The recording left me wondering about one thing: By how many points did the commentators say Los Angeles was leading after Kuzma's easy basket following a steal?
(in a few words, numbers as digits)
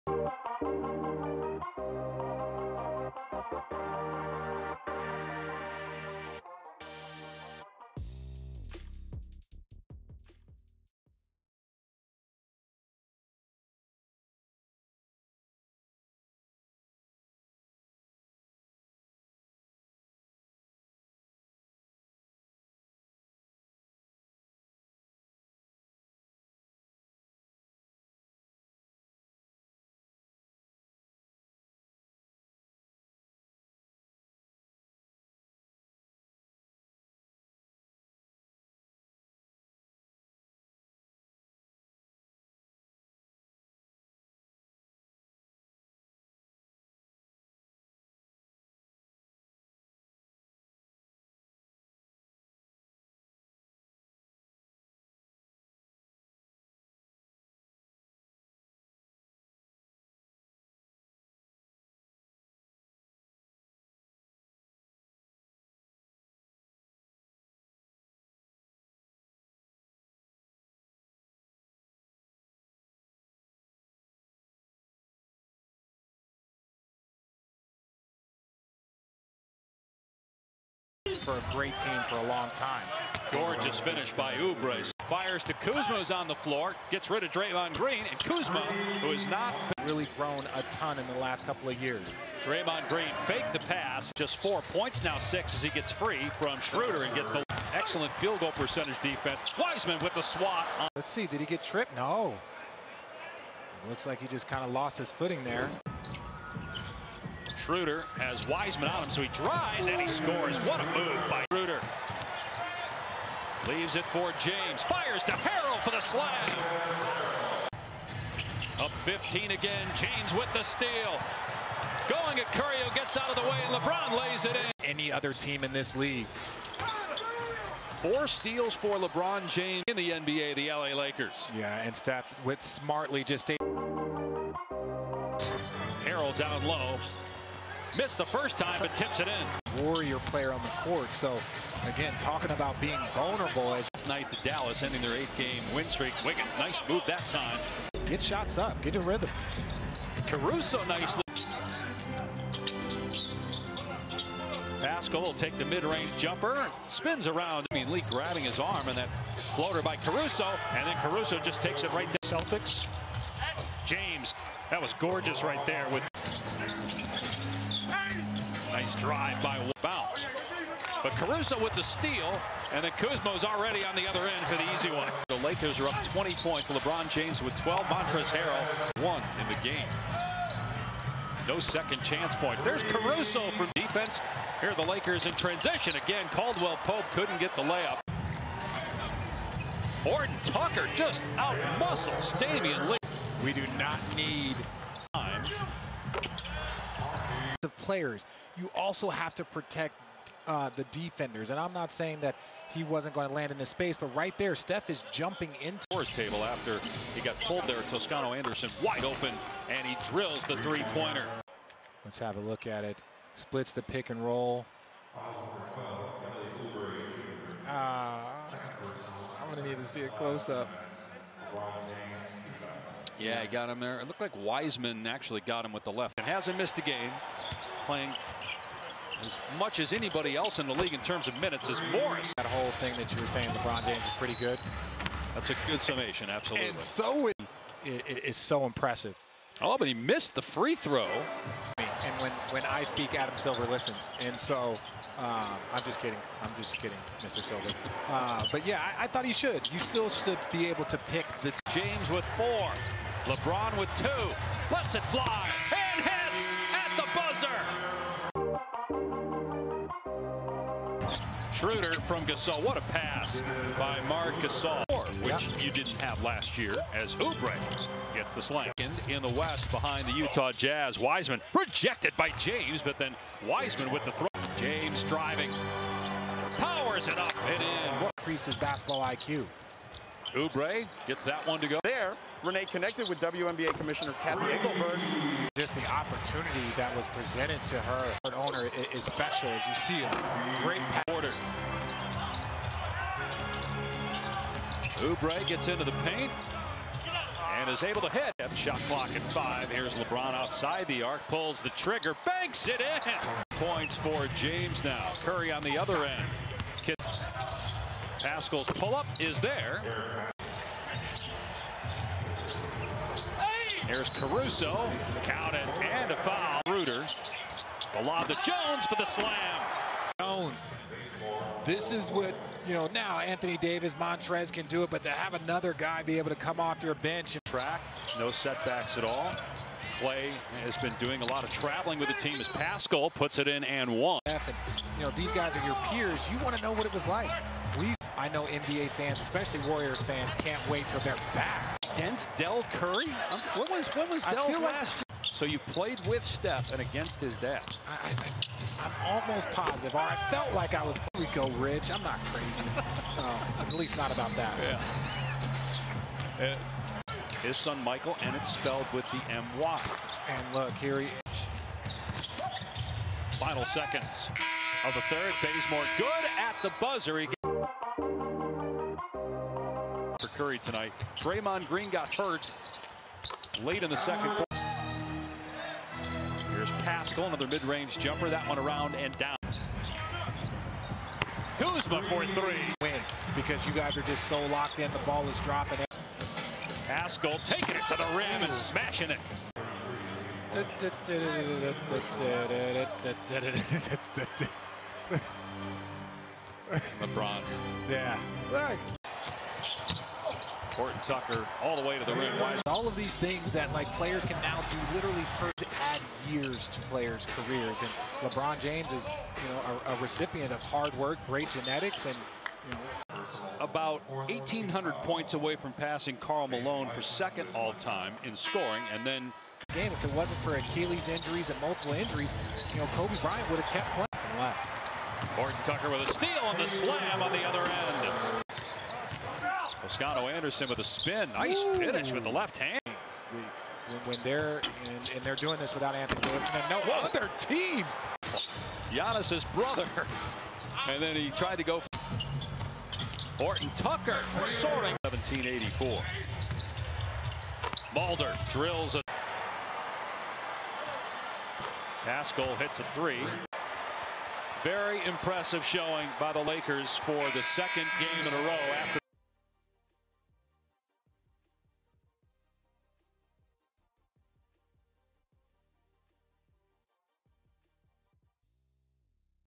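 20.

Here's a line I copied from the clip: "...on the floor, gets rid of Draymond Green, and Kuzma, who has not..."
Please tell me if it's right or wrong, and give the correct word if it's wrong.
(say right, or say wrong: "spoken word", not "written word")
right.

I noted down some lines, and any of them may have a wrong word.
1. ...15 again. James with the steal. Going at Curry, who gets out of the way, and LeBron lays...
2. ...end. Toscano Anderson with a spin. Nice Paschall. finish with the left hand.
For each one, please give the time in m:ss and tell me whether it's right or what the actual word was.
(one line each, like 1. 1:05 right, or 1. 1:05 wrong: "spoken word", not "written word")
1. 1:58 right
2. 7:07 wrong: "Ooh", not "Paschall".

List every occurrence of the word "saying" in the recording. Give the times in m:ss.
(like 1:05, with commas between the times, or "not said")
3:21, 3:53.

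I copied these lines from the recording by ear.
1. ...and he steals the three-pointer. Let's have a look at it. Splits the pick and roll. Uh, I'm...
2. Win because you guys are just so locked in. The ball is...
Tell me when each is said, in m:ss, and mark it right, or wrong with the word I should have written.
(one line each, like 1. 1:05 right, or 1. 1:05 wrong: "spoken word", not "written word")
1. 3:29 wrong: "drills", not "steals"
2. 6:22 right.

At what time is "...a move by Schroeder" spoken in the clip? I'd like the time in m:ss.
1:50.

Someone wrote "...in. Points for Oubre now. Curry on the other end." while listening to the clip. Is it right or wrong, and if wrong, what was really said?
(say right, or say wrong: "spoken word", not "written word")
wrong: "James", not "Oubre".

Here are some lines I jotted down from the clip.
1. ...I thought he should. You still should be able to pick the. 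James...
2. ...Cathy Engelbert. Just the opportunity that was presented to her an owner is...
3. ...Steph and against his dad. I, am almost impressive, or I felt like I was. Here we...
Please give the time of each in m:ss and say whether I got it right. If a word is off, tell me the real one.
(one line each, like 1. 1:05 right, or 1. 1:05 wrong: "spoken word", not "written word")
1. 4:09 right
2. 4:44 right
3. 5:46 wrong: "positive", not "impressive".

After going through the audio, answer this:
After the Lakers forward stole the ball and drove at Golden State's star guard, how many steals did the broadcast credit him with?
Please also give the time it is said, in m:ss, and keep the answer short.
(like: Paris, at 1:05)
4, at 2:08.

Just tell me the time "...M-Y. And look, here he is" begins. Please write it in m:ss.
5:59.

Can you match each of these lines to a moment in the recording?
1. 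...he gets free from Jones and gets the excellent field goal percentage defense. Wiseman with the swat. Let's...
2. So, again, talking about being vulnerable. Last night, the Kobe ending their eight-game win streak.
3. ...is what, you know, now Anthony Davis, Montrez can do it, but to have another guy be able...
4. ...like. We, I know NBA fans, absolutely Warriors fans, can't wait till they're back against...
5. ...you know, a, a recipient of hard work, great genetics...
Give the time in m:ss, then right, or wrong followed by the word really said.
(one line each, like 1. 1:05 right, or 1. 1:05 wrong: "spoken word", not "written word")
1. 1:35 wrong: "Schroeder", not "Jones"
2. 2:21 wrong: "Dallas", not "Kobe"
3. 5:21 right
4. 5:37 wrong: "especially", not "absolutely"
5. 6:49 right.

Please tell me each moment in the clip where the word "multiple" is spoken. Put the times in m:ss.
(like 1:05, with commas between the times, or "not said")
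7:01.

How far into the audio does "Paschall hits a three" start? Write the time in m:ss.
7:32.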